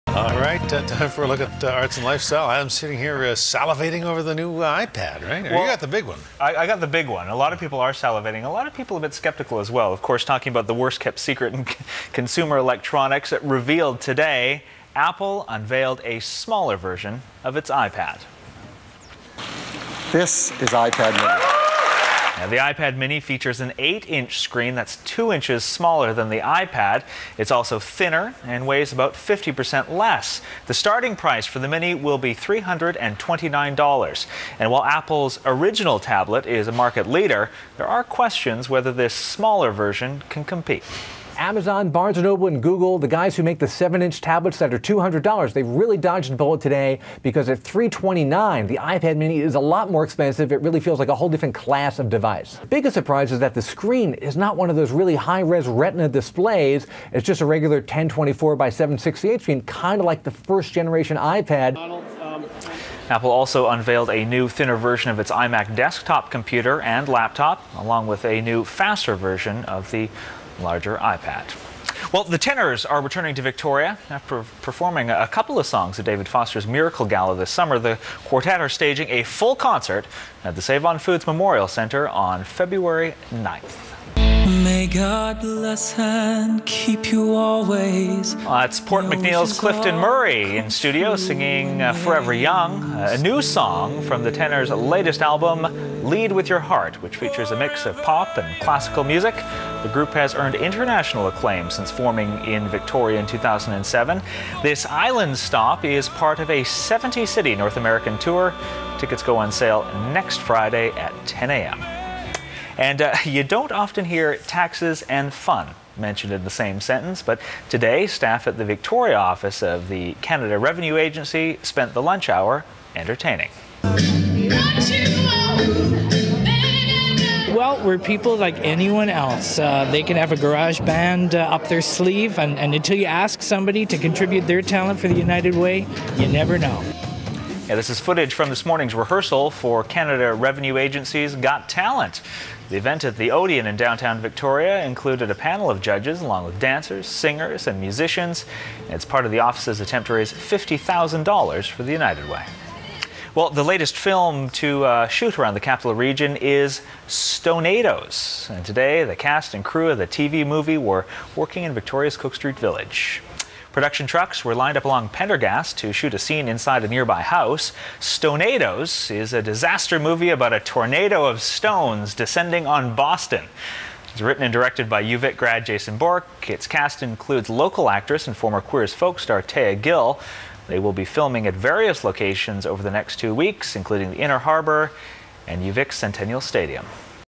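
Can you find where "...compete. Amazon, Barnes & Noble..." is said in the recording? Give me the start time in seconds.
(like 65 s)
40 s.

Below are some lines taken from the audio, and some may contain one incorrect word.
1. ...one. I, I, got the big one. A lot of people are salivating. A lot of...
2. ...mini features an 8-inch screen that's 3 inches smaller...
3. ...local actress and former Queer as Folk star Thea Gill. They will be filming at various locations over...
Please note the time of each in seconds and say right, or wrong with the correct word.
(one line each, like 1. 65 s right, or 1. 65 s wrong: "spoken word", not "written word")
1. 6 s right
2. 22 s wrong: "2", not "3"
3. 177 s right.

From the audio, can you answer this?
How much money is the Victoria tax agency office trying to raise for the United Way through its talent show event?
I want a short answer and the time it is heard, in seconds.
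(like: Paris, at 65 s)
$50,000, at 150 s.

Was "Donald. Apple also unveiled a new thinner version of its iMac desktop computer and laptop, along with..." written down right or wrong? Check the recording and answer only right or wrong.
right.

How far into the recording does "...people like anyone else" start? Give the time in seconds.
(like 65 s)
127 s.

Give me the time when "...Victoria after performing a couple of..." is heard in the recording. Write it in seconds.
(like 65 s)
73 s.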